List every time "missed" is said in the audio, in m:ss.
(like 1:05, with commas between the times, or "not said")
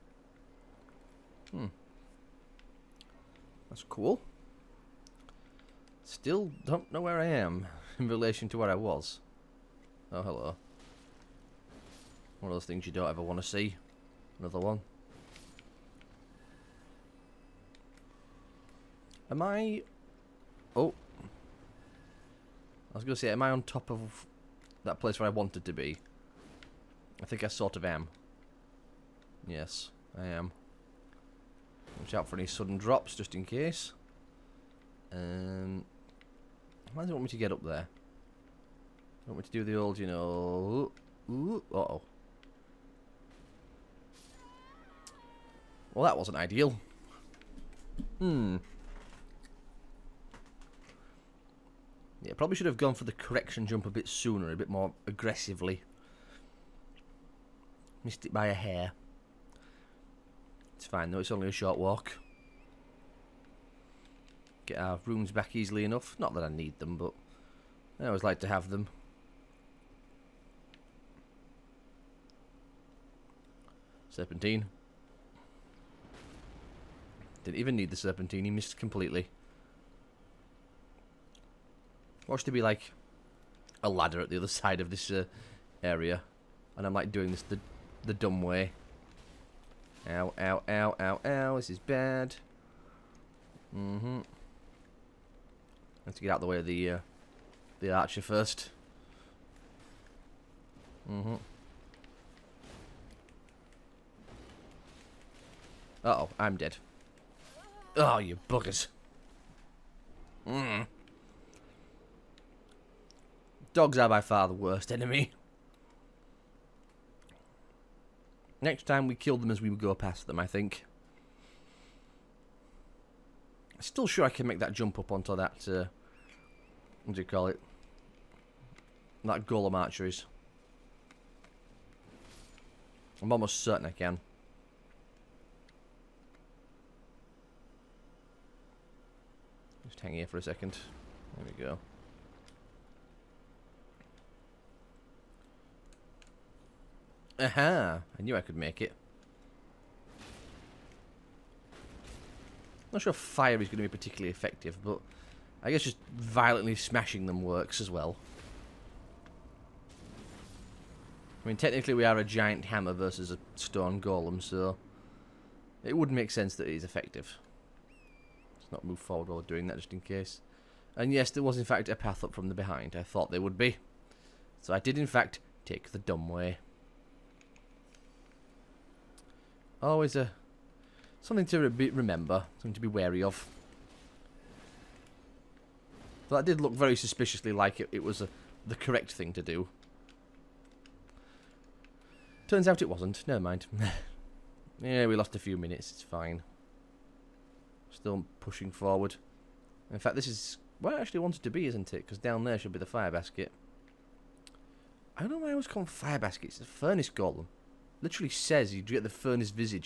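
0:58, 1:18.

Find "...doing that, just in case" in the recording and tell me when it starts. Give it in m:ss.
2:49.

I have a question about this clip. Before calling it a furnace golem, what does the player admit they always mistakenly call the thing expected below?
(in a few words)
Fire baskets.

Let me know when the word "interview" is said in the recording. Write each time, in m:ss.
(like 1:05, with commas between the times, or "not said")
not said.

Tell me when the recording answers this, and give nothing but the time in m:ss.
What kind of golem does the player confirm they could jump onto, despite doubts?
2:09.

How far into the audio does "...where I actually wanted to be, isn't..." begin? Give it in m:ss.
3:20.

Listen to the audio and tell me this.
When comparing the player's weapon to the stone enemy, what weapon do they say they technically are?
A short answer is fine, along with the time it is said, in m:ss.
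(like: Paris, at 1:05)
A giant hammer, at 2:42.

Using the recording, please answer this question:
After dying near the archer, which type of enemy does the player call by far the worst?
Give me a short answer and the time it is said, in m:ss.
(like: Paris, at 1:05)
Dogs, at 1:53.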